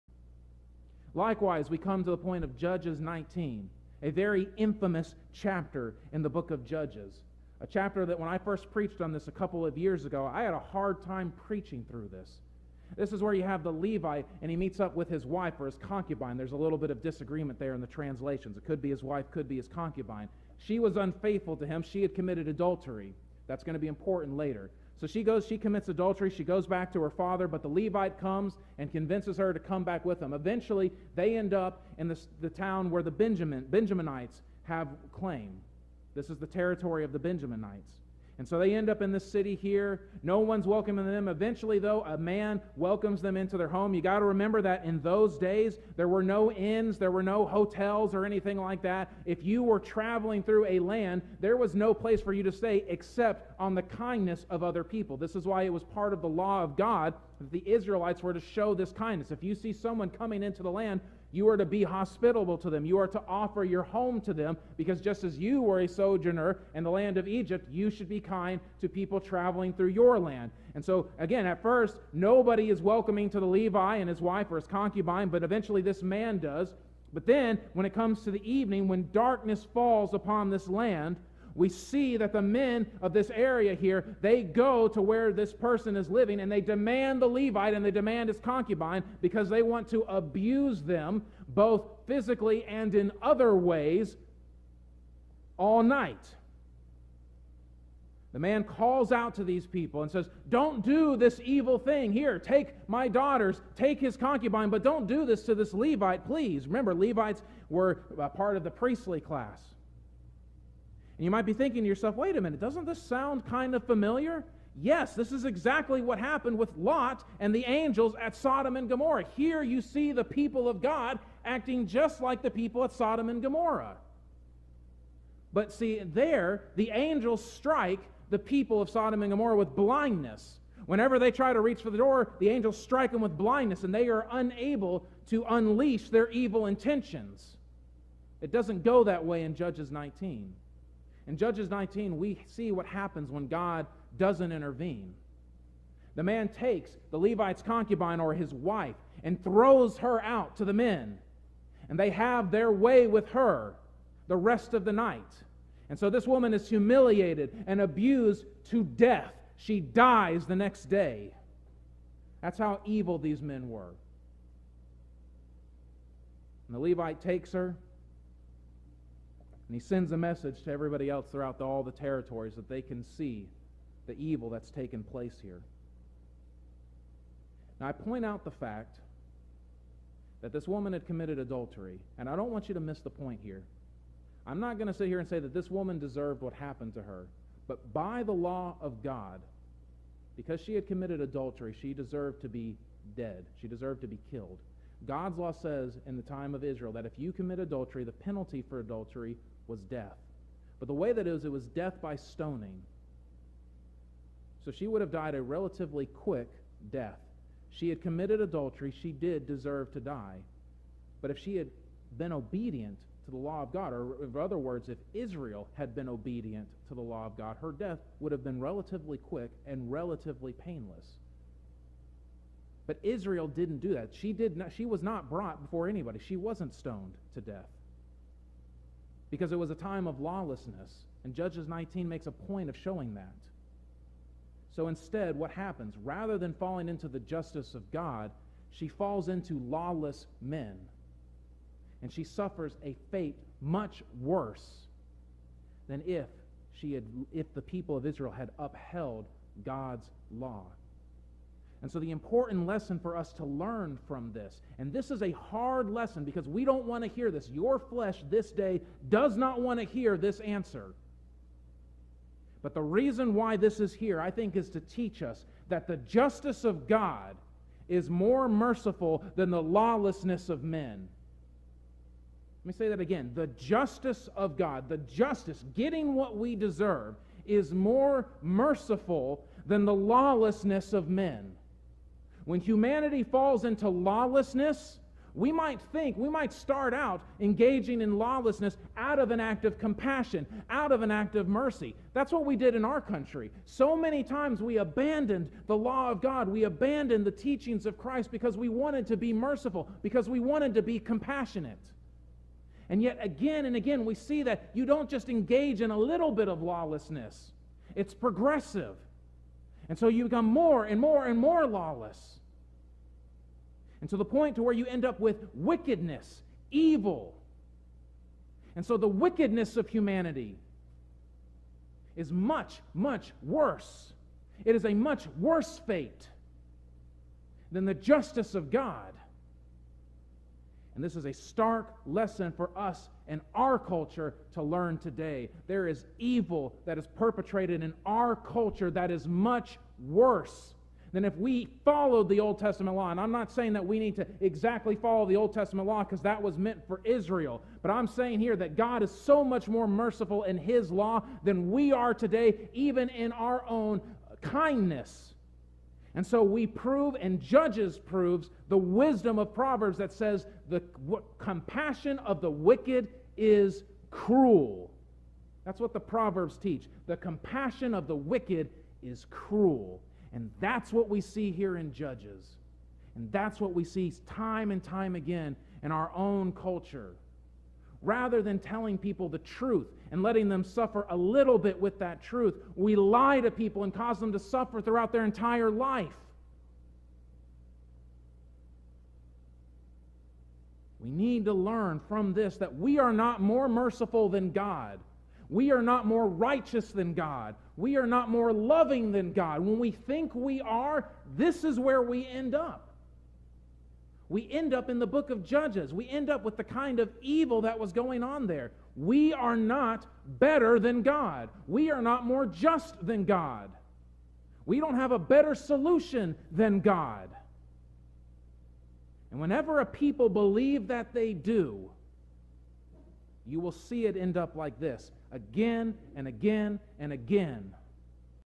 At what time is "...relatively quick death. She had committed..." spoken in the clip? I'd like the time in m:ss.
3:25.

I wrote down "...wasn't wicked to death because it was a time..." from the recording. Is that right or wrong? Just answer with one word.
wrong.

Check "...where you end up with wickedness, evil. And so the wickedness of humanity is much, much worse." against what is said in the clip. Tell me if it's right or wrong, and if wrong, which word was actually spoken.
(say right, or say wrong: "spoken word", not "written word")
right.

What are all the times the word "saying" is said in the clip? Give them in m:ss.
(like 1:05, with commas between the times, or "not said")
5:43, 5:48.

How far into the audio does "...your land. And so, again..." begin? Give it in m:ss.
1:09.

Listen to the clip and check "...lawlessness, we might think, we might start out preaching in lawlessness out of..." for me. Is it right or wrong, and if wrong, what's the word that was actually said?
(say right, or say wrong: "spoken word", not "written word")
wrong: "engaging", not "preaching".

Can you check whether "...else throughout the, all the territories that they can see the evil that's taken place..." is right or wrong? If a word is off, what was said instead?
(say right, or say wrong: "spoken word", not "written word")
right.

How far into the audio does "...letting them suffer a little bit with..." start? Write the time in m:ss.
6:20.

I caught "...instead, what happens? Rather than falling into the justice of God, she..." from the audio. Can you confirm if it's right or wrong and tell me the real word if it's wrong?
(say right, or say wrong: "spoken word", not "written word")
right.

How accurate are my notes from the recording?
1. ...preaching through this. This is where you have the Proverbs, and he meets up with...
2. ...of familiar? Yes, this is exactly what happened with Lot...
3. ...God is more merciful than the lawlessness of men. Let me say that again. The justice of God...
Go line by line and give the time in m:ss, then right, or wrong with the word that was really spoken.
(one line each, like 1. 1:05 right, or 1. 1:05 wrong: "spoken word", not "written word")
1. 0:11 wrong: "Levite", not "Proverbs"
2. 1:53 right
3. 4:26 right.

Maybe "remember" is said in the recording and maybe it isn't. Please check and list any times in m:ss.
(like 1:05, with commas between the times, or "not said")
0:44, 1:46.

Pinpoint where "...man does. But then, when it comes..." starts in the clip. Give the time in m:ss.
1:16.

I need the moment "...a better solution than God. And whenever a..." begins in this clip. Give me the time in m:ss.
6:55.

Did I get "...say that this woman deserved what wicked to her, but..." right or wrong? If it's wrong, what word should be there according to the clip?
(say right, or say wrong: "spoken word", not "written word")
wrong: "happened", not "wicked".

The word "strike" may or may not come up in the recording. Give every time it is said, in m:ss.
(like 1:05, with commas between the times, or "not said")
2:07, 2:12.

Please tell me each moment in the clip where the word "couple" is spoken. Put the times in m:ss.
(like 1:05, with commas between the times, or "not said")
0:09.